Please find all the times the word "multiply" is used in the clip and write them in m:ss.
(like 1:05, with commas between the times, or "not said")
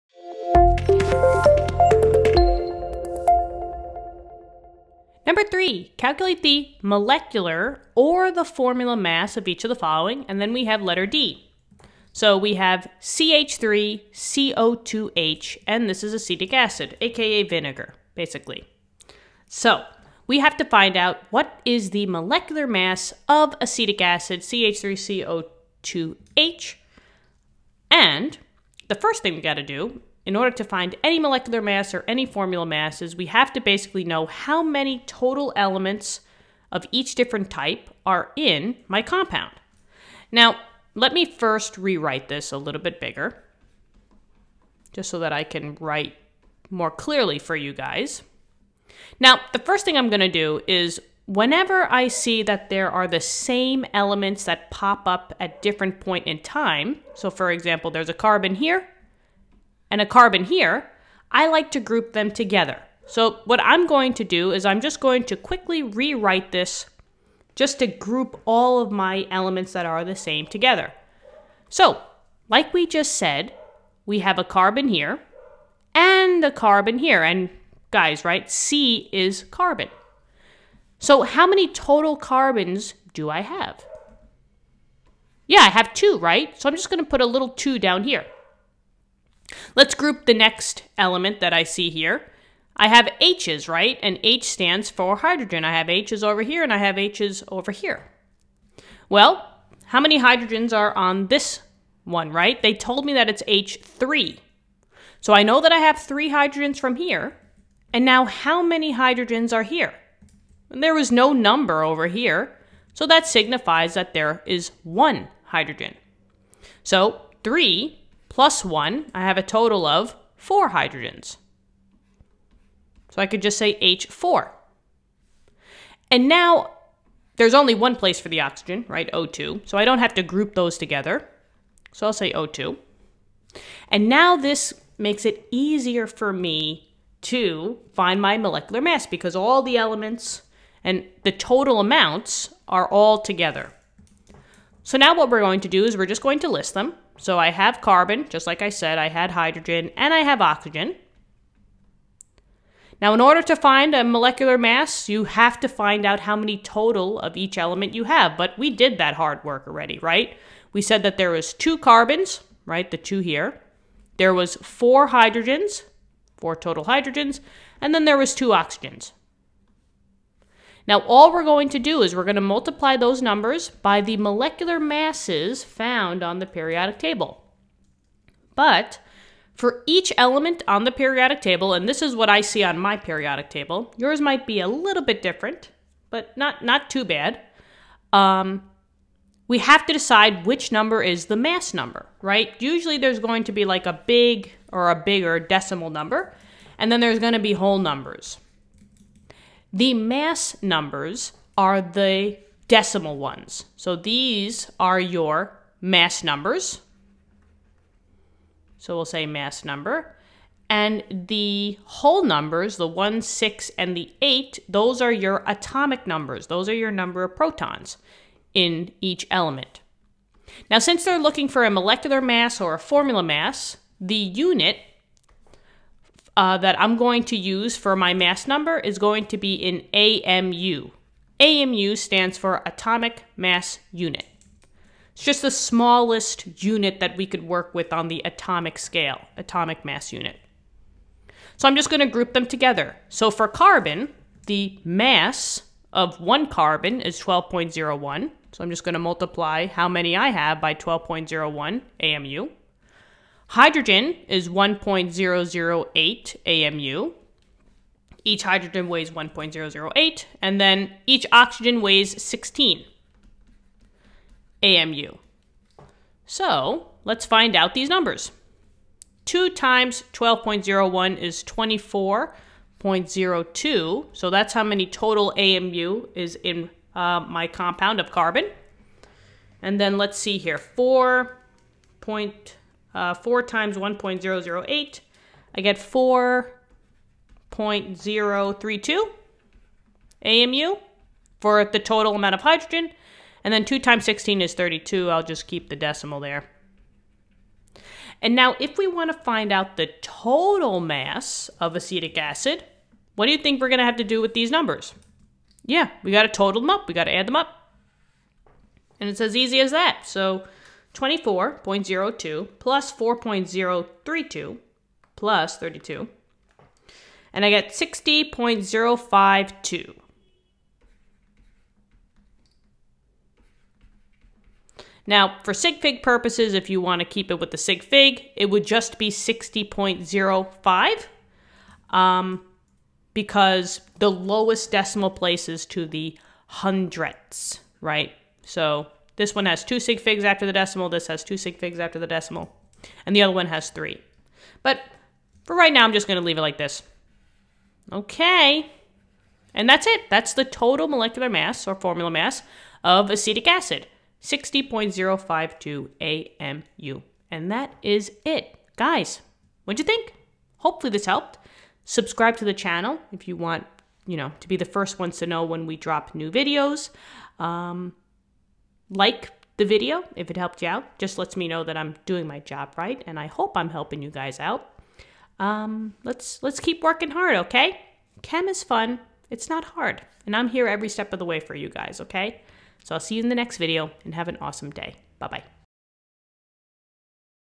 2:52, 4:08.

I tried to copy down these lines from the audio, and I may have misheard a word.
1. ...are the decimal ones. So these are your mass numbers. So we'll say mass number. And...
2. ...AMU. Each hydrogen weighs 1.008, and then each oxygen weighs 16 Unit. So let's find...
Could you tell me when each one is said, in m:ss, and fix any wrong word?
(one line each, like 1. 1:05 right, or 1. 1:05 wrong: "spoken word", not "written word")
1. 3:21 right
2. 4:16 wrong: "AMU", not "Unit".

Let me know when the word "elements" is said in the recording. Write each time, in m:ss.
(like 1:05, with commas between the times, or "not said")
0:35, 0:53, 1:09, 1:30, 2:19, 2:37, 3:00, 3:39.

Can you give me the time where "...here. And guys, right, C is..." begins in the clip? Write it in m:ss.
1:16.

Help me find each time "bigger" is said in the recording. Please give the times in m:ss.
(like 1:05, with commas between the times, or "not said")
0:42, 3:14.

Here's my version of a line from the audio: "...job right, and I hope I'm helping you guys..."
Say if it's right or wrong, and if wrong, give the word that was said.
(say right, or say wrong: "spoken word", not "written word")
right.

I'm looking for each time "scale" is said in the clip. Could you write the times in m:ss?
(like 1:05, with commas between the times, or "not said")
3:58.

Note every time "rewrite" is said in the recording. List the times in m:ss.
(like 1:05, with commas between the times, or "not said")
0:41, 1:05.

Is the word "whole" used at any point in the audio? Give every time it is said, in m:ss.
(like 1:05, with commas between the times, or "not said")
3:17, 3:31.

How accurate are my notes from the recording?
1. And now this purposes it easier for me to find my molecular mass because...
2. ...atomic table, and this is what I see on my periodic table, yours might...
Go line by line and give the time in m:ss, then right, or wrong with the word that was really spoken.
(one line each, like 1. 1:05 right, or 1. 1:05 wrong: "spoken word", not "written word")
1. 2:13 wrong: "makes", not "purposes"
2. 3:00 wrong: "periodic", not "atomic".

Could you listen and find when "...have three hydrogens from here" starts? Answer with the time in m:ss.
1:45.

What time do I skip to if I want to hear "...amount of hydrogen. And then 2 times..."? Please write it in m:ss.
4:52.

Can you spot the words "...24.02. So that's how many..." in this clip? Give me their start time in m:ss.
4:31.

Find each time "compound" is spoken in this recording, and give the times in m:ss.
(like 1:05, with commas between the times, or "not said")
0:39, 4:37.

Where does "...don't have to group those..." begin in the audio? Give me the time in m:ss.
2:09.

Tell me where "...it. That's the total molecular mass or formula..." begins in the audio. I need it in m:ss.
5:49.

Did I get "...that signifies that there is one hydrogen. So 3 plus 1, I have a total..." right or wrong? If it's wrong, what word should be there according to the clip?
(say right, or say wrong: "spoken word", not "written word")
right.